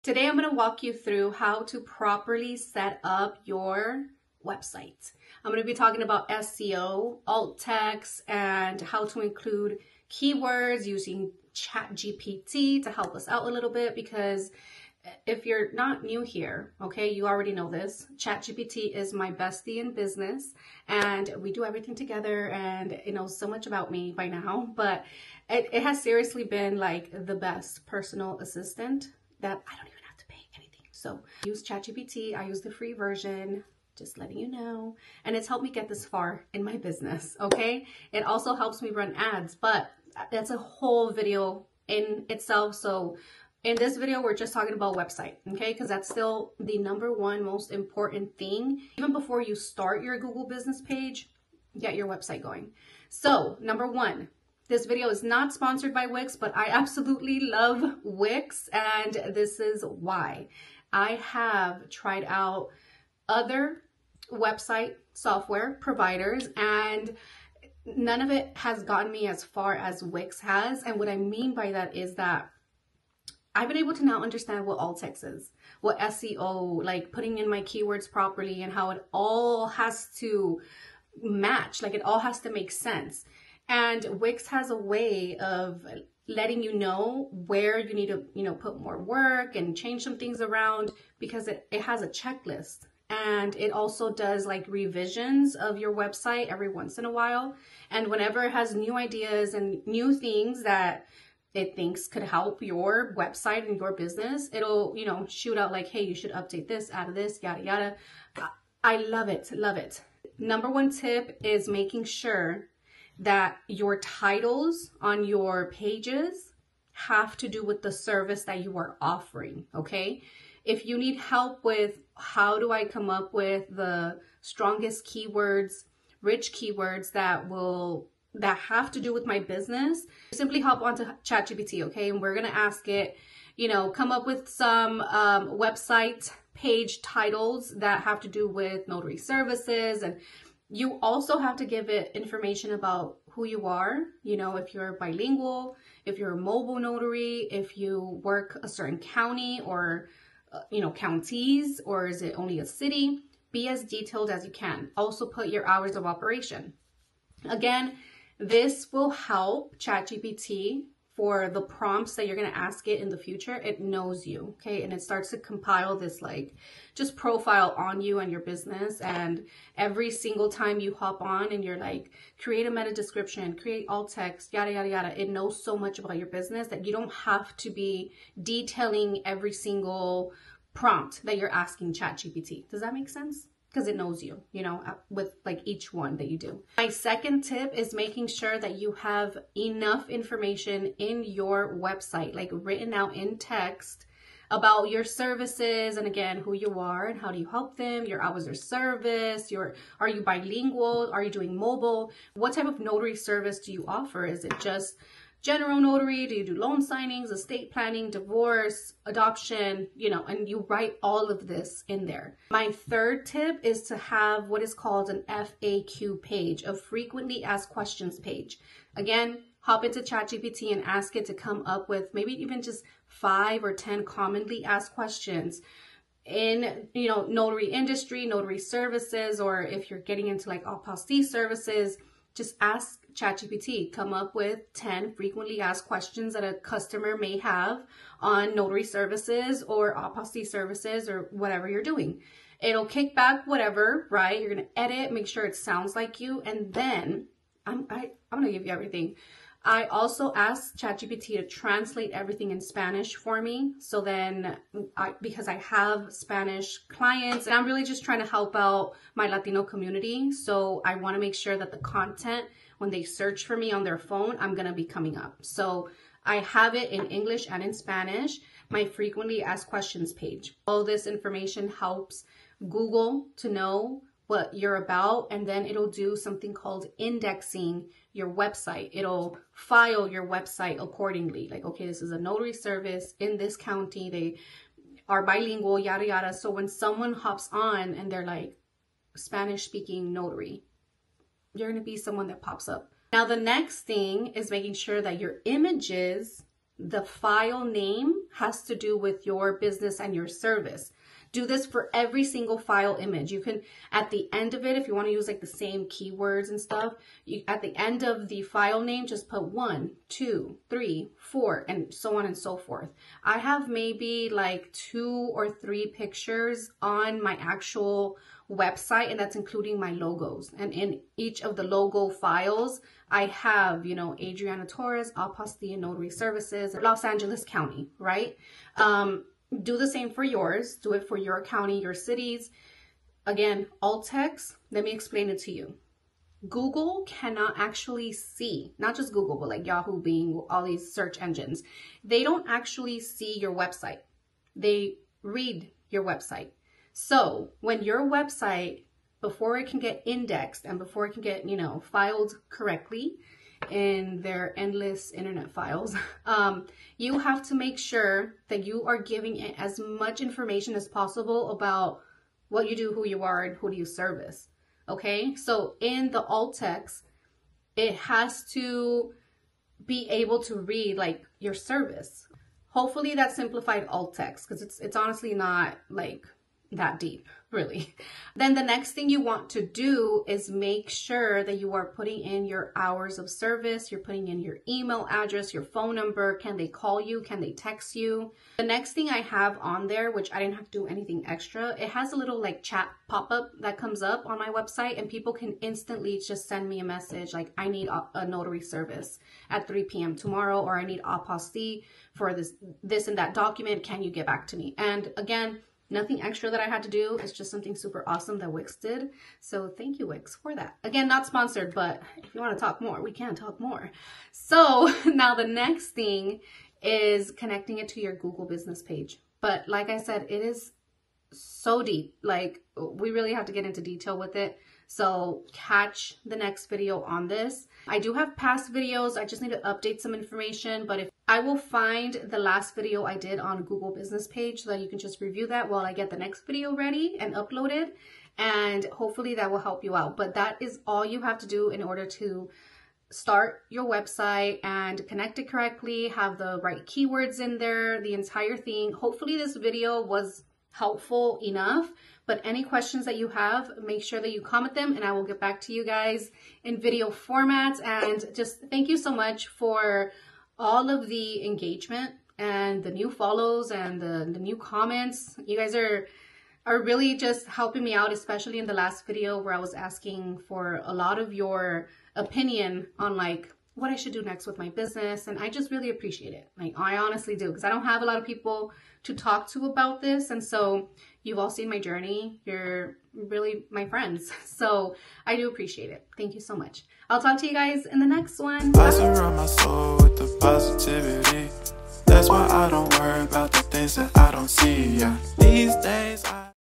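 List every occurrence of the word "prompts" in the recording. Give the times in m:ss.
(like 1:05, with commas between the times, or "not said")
2:41, 3:00.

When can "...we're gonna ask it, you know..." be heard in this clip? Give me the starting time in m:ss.
2:12.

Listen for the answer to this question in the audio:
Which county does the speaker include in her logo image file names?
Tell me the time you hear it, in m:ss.
5:26.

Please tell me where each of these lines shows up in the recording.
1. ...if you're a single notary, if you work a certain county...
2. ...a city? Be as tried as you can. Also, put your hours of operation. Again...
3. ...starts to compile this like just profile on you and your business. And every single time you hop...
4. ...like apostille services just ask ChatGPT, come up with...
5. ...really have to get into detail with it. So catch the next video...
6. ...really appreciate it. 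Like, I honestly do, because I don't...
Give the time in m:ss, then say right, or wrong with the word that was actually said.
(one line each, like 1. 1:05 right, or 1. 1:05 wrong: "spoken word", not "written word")
1. 2:26 wrong: "mobile", not "single"
2. 2:32 wrong: "detailed", not "tried"
3. 2:45 right
4. 3:50 right
5. 7:03 right
6. 7:55 right.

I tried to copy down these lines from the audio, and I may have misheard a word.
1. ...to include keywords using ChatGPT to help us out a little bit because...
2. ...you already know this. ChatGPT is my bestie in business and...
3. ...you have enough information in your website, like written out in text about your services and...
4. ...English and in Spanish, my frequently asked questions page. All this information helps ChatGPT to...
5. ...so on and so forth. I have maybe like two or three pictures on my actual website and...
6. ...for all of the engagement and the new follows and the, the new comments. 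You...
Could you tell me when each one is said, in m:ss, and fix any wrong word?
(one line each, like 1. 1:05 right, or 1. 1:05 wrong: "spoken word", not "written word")
1. 0:09 right
2. 0:17 right
3. 3:08 right
4. 4:27 wrong: "Google", not "ChatGPT"
5. 5:11 right
6. 7:39 right.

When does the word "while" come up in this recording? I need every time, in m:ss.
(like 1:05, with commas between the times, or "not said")
1:37, 7:15.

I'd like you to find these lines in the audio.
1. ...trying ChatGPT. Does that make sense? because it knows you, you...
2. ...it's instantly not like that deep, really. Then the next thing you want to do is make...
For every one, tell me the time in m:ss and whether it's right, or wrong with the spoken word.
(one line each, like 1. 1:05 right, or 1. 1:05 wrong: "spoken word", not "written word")
1. 3:01 wrong: "asking", not "trying"
2. 6:14 wrong: "honestly", not "instantly".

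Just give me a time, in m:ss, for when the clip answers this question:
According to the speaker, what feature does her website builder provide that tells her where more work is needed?
1:32.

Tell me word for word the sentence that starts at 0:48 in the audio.
Even before you start your Google business page, get your website going.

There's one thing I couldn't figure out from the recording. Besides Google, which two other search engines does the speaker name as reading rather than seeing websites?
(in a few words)
Yahoo, Bing.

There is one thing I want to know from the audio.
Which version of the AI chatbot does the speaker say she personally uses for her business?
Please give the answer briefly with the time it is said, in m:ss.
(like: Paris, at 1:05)
free version, at 0:32.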